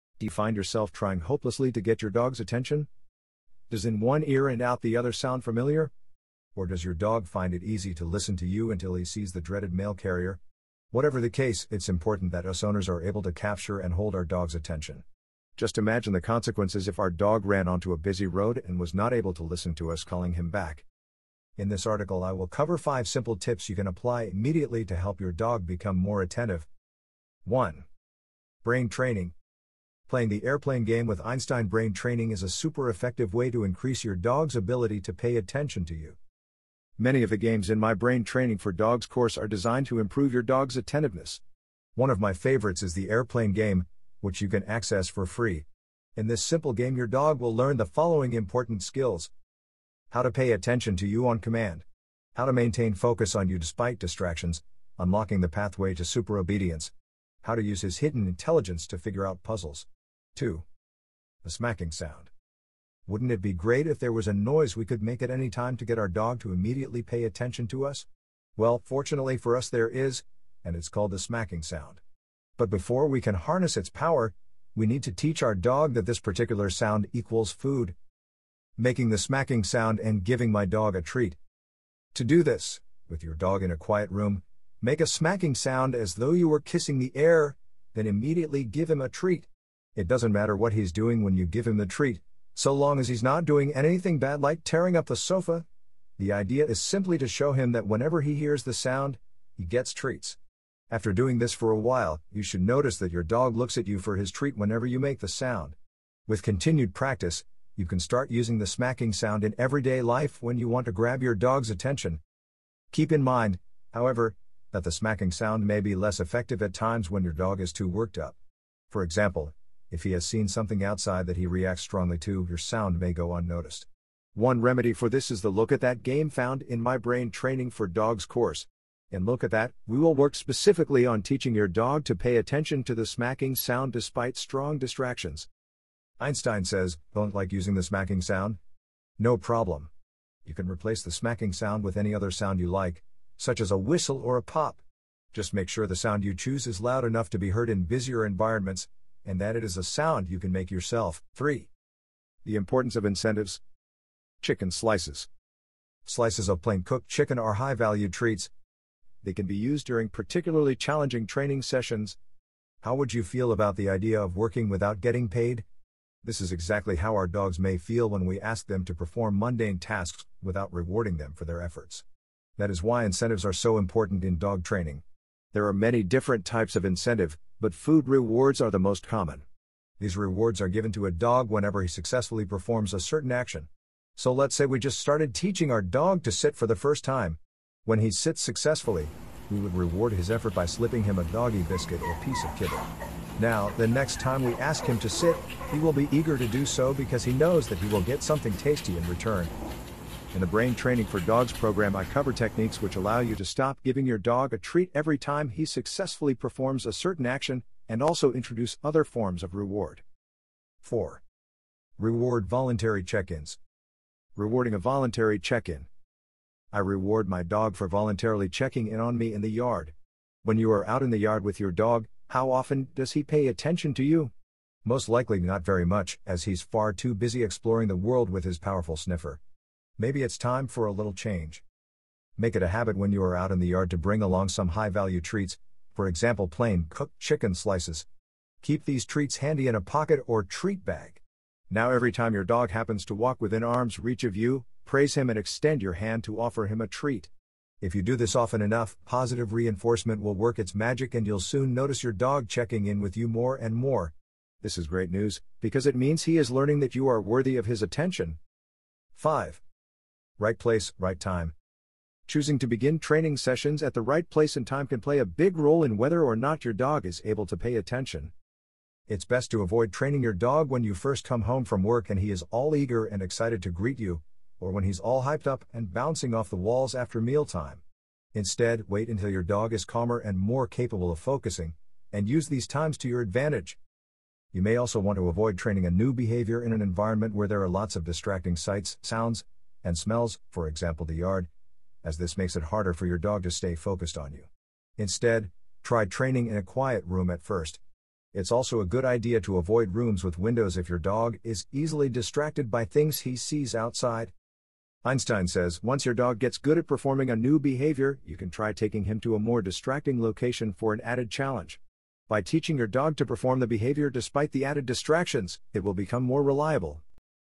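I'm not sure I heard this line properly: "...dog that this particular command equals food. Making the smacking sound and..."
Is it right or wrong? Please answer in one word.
wrong.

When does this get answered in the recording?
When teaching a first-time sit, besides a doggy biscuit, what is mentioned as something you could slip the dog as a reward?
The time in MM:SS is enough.
03:12.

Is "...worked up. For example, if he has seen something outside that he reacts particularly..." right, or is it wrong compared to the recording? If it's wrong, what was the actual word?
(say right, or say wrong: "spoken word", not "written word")
wrong: "strongly", not "particularly".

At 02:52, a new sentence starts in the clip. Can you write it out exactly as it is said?
That is why incentives are so important in dog training.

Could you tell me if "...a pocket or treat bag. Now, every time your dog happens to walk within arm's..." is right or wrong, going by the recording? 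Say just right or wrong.
right.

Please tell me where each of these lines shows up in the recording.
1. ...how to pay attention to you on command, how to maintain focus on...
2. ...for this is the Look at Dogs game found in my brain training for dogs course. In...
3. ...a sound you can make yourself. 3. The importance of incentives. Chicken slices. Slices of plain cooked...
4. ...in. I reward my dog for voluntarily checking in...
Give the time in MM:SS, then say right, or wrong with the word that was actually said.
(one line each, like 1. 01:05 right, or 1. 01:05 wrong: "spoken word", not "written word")
1. 00:50 right
2. 02:04 wrong: "That", not "Dogs"
3. 02:29 right
4. 03:35 right.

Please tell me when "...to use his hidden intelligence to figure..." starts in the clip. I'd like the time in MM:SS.
00:57.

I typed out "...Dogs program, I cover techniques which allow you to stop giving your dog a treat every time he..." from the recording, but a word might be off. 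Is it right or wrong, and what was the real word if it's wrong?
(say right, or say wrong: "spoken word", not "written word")
right.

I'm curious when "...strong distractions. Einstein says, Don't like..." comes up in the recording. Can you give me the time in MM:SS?
02:14.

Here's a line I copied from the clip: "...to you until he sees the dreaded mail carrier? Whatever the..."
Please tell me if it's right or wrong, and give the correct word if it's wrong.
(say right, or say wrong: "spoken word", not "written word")
right.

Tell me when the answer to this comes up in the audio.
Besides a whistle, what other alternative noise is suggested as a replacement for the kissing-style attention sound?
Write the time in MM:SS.
02:24.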